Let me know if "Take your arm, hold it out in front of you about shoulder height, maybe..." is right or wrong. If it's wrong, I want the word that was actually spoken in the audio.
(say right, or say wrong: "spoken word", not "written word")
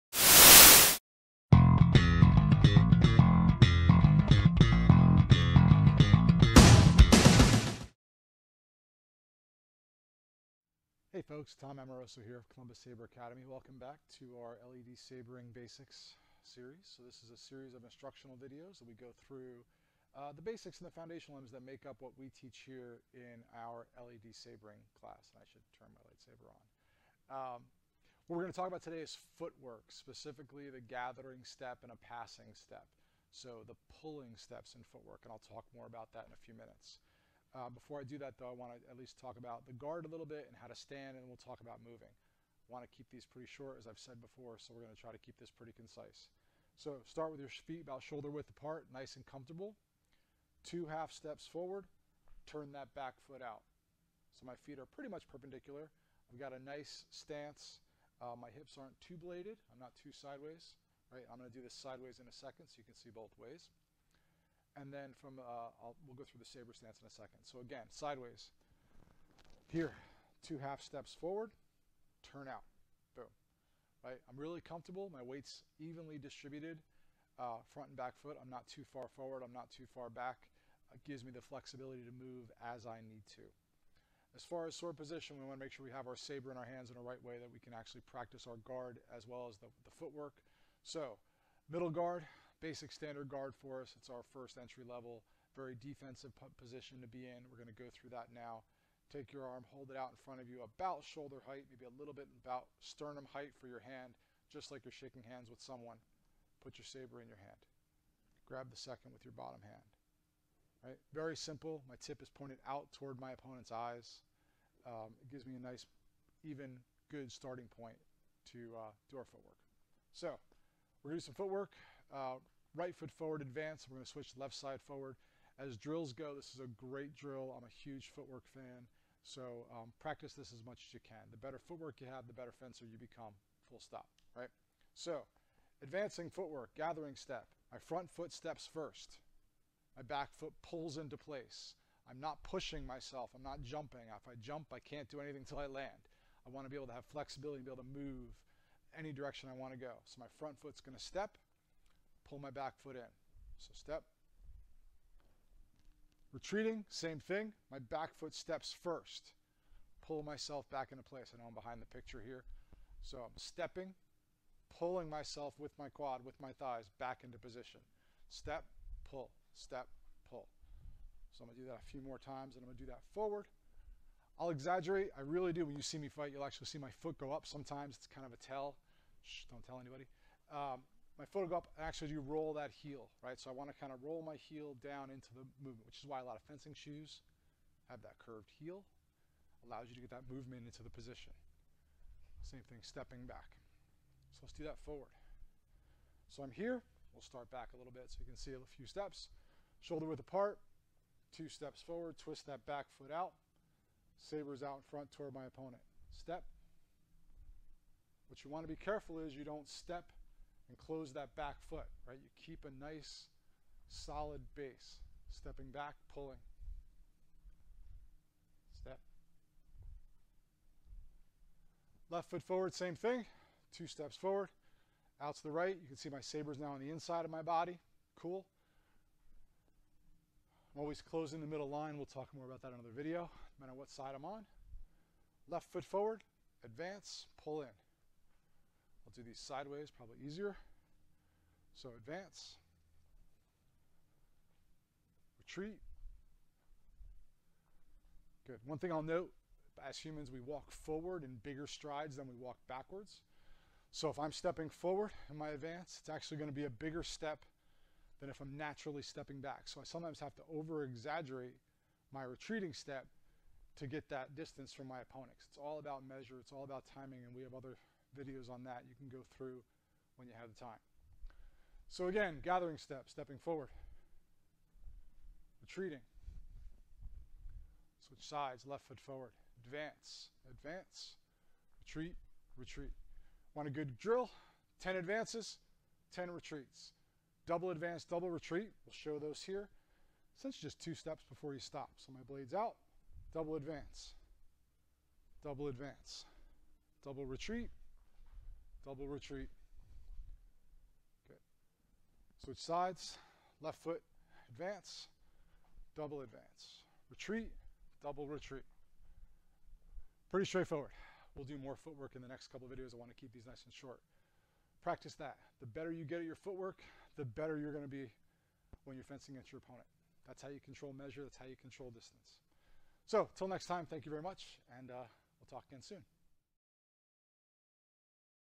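right.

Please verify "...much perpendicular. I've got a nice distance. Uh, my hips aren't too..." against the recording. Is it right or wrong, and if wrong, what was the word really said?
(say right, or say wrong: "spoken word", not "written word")
wrong: "stance", not "distance".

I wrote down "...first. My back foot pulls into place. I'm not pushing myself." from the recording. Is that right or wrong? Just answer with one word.
right.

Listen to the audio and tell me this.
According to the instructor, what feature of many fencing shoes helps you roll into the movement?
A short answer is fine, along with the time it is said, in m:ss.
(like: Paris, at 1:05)
Curved heel, at 3:08.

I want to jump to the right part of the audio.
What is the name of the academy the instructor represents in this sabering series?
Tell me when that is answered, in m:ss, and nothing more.
0:12.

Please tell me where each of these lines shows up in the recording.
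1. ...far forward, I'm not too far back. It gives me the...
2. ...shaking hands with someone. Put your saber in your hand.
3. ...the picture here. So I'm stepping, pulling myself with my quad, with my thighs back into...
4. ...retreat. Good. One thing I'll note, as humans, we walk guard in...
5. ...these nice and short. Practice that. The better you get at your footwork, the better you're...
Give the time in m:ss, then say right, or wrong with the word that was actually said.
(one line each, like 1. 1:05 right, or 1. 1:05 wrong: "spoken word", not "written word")
1. 1:18 right
2. 1:44 right
3. 2:41 right
4. 4:05 wrong: "forward", not "guard"
5. 5:13 right.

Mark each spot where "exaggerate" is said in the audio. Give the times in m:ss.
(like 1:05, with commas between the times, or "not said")
2:54, 4:20.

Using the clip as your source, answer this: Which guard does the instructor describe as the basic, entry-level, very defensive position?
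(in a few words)
Middle guard.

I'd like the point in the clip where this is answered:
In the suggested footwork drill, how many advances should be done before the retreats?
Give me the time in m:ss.
4:44.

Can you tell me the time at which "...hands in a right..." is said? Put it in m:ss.
1:26.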